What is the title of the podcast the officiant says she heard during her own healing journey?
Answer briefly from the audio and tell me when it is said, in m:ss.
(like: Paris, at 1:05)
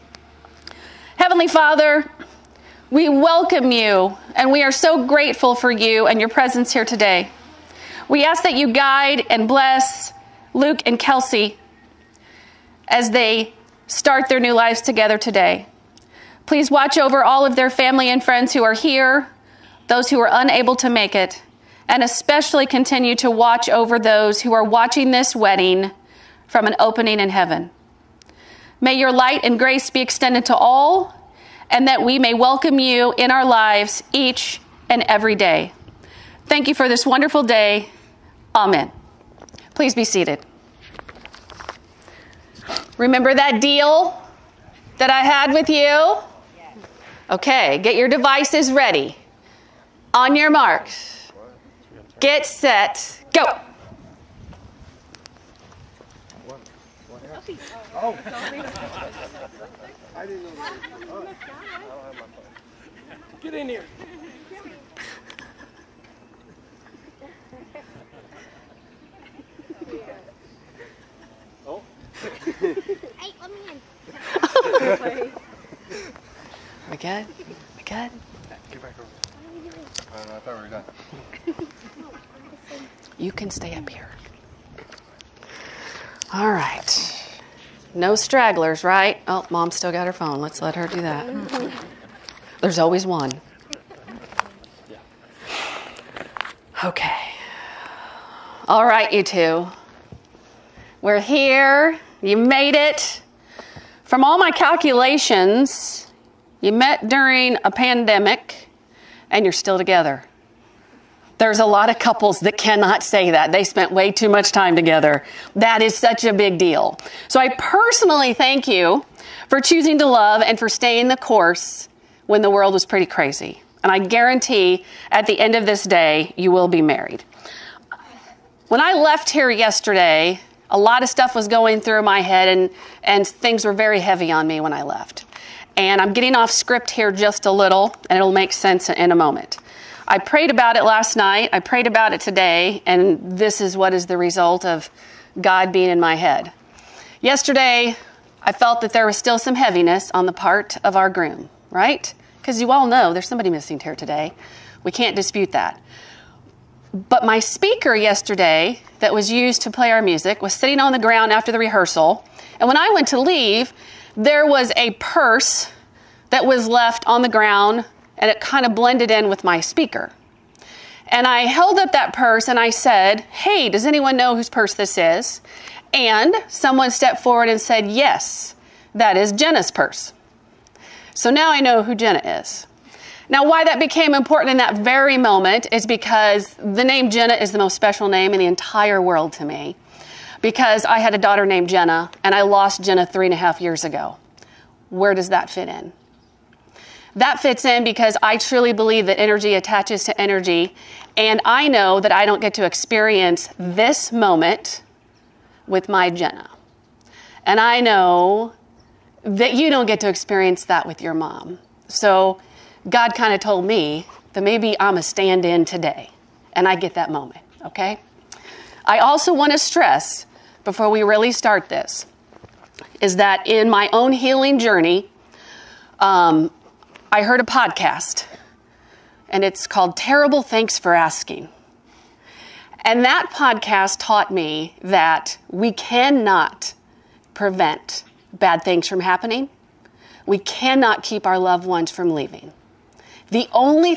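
Terrible Thanks for Asking, at 3:49.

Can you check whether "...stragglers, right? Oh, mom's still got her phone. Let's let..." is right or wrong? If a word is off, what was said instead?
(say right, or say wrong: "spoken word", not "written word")
right.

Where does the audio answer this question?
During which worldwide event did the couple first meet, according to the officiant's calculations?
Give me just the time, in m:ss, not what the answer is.
1:47.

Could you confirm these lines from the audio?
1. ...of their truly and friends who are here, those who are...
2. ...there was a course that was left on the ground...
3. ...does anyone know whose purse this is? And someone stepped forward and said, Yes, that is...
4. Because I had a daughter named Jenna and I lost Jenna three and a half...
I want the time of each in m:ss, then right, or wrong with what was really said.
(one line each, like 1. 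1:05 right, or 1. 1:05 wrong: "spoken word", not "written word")
1. 0:17 wrong: "family", not "truly"
2. 2:44 wrong: "purse", not "course"
3. 2:53 right
4. 3:10 right.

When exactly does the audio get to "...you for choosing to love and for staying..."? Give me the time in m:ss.
1:58.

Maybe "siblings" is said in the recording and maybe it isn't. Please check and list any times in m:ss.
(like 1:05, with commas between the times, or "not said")
not said.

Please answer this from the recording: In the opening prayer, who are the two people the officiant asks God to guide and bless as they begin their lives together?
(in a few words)
Luke and Kelsey.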